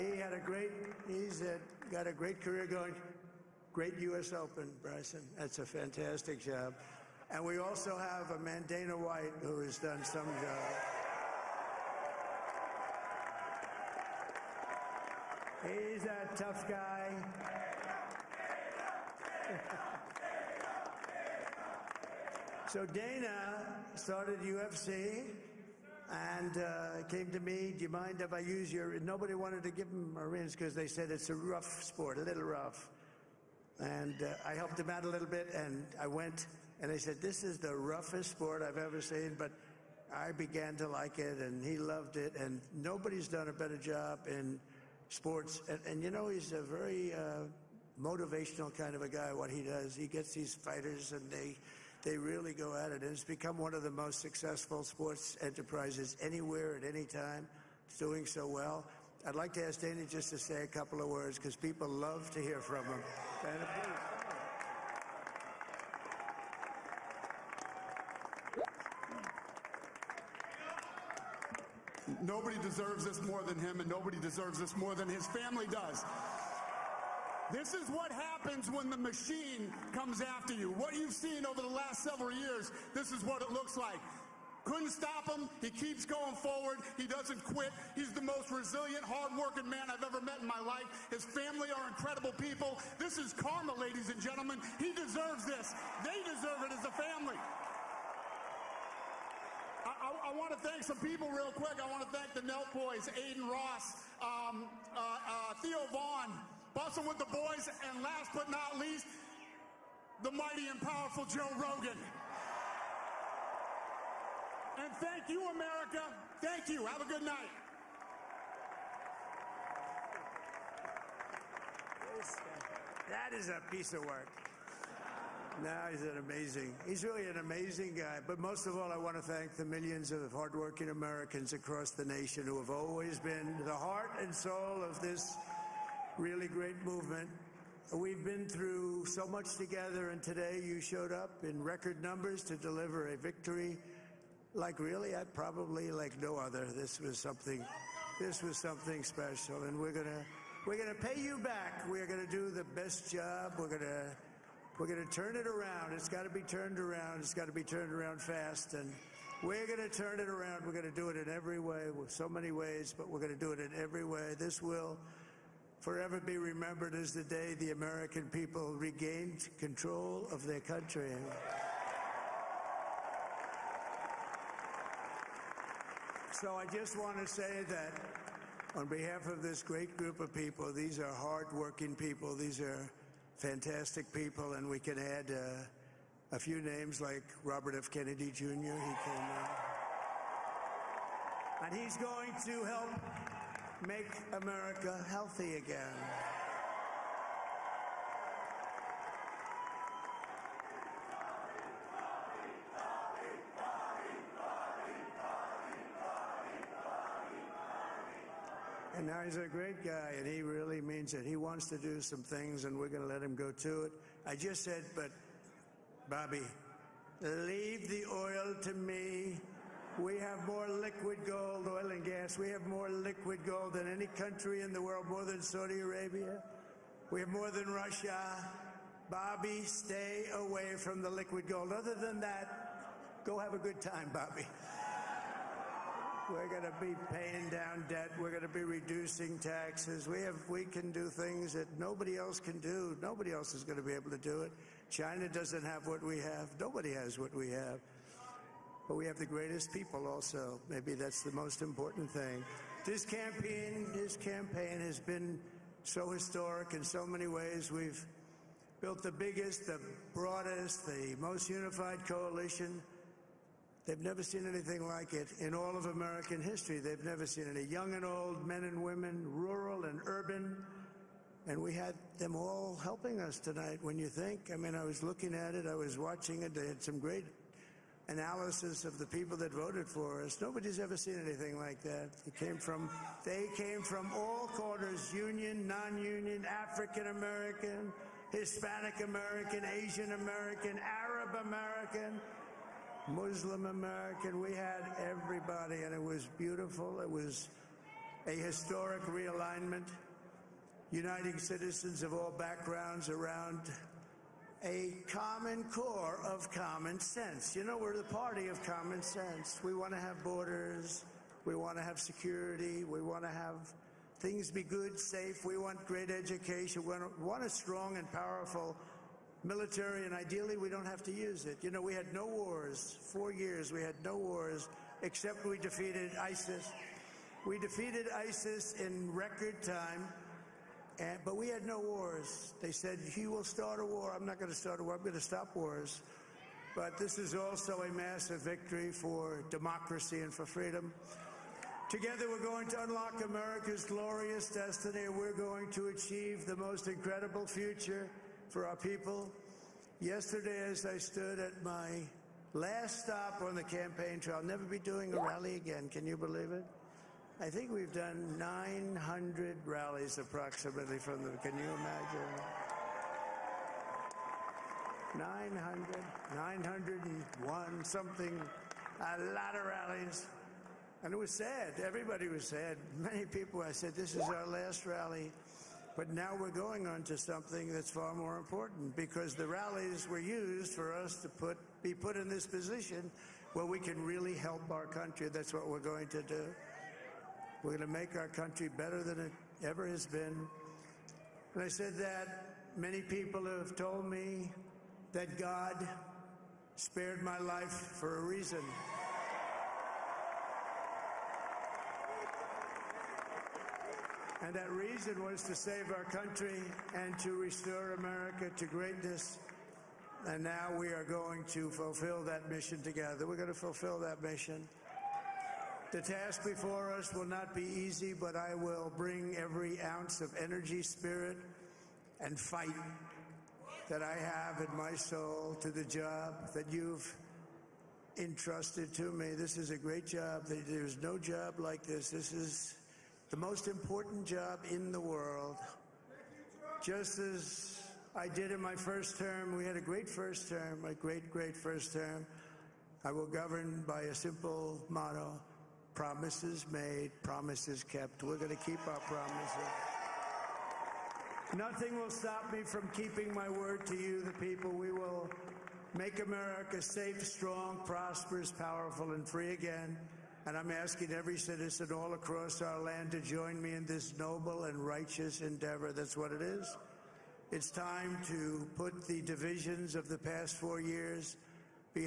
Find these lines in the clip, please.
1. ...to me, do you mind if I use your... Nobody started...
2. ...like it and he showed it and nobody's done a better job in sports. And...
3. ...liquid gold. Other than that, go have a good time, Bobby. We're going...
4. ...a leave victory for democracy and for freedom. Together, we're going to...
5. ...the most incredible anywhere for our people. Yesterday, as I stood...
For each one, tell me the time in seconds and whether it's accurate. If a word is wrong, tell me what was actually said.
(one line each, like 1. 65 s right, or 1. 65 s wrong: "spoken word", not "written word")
1. 27 s wrong: "wanted", not "started"
2. 40 s wrong: "loved", not "showed"
3. 231 s right
4. 337 s wrong: "massive", not "leave"
5. 346 s wrong: "future", not "anywhere".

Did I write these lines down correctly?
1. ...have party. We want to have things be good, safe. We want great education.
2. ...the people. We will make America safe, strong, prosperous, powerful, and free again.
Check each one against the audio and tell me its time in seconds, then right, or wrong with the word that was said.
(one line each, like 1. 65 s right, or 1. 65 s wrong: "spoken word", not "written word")
1. 311 s wrong: "security", not "party"
2. 454 s right.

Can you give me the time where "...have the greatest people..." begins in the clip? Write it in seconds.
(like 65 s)
249 s.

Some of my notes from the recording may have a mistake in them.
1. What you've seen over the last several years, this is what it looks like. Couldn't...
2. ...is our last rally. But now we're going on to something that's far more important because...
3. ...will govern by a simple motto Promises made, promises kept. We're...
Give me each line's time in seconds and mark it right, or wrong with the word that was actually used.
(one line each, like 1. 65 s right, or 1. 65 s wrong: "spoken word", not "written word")
1. 80 s right
2. 374 s right
3. 443 s right.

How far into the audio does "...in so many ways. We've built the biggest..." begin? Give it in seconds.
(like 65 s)
256 s.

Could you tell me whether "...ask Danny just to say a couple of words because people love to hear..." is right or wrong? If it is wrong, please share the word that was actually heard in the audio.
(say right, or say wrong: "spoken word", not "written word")
right.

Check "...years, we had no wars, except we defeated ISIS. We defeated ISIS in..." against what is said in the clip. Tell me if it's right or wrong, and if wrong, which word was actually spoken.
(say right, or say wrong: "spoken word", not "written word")
right.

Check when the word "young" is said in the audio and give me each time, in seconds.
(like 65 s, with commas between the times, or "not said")
267 s.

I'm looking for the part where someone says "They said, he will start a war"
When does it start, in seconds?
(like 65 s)
332 s.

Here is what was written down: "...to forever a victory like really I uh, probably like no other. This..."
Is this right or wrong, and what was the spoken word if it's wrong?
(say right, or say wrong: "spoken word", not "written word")
wrong: "deliver", not "forever".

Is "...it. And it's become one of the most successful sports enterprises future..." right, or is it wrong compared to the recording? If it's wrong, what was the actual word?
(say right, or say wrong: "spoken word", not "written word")
wrong: "anywhere", not "future".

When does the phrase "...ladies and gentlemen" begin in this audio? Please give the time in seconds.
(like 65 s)
93 s.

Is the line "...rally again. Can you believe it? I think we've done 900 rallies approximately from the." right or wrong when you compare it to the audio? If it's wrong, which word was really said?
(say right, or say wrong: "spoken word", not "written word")
right.